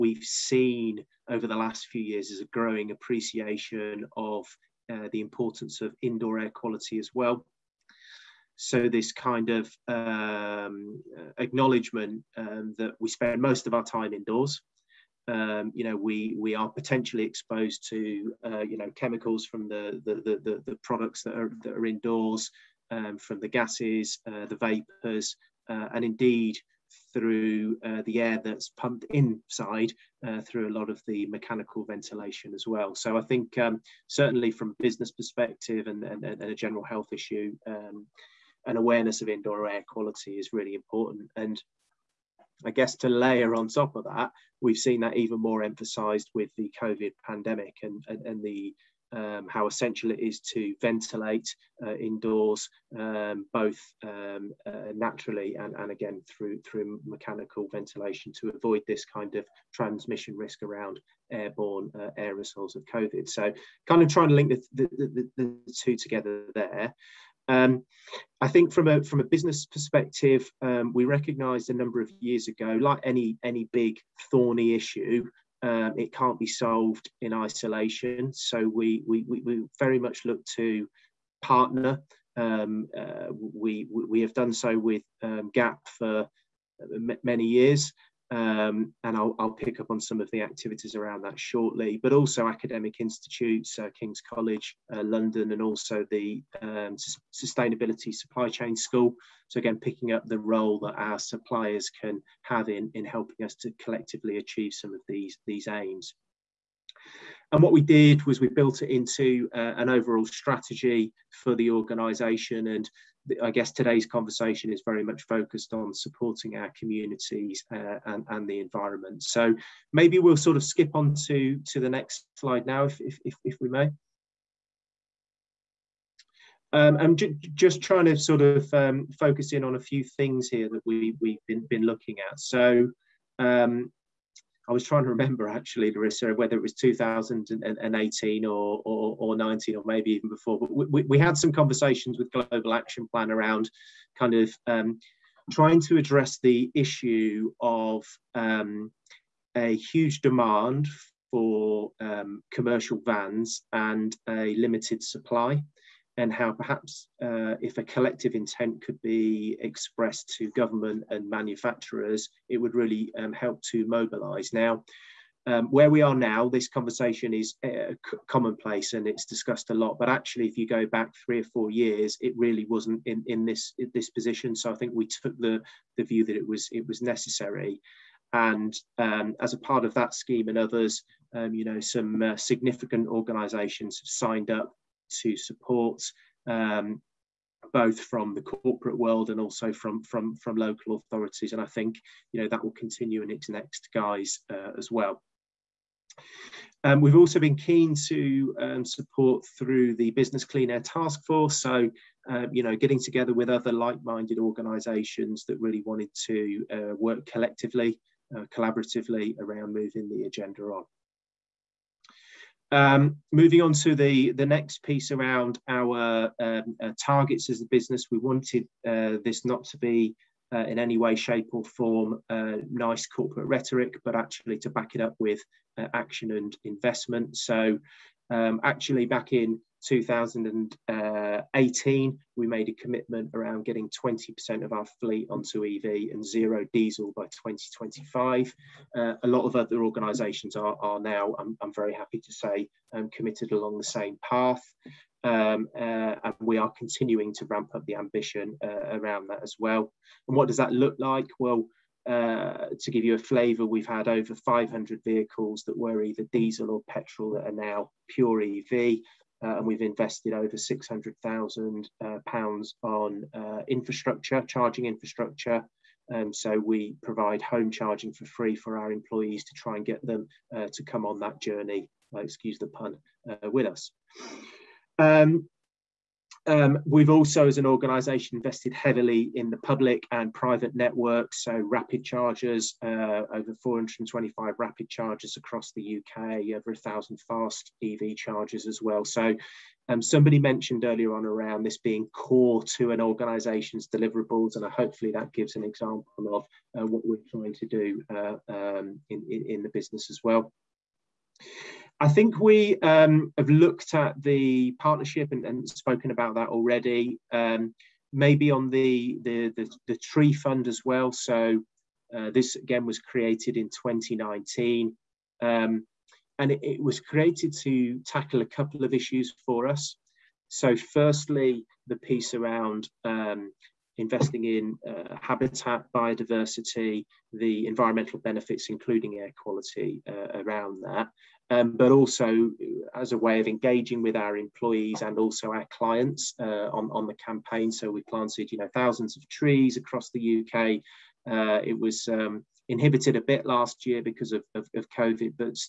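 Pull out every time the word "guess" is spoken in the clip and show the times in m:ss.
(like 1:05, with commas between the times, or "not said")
0:42, 1:53.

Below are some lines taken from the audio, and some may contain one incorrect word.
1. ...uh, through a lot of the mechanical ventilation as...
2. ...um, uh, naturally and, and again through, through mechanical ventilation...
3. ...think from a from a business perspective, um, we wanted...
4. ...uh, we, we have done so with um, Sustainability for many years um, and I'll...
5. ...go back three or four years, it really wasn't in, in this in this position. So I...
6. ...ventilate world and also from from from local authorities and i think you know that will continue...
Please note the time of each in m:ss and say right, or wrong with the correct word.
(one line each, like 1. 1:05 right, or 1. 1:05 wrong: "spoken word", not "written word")
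1. 0:30 right
2. 0:54 right
3. 1:08 wrong: "recognised", not "wanted"
4. 1:22 wrong: "GAP", not "Sustainability"
5. 2:50 right
6. 3:08 wrong: "corporate", not "ventilate".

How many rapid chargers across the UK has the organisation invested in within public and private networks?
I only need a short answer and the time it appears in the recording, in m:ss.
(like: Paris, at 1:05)
Over 425, at 4:43.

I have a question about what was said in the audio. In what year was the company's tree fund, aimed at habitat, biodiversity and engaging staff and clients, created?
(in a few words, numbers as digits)
2019.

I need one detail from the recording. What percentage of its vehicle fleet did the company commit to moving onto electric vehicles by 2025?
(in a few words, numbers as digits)
20%.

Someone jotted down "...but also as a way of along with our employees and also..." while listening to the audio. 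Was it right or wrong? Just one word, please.
wrong.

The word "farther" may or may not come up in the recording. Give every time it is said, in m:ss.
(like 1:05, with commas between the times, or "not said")
not said.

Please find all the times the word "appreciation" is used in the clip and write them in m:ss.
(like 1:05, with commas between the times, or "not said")
0:02.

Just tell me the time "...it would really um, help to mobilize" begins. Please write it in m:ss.
2:42.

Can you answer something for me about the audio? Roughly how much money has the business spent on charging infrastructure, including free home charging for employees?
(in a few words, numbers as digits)
£600,000.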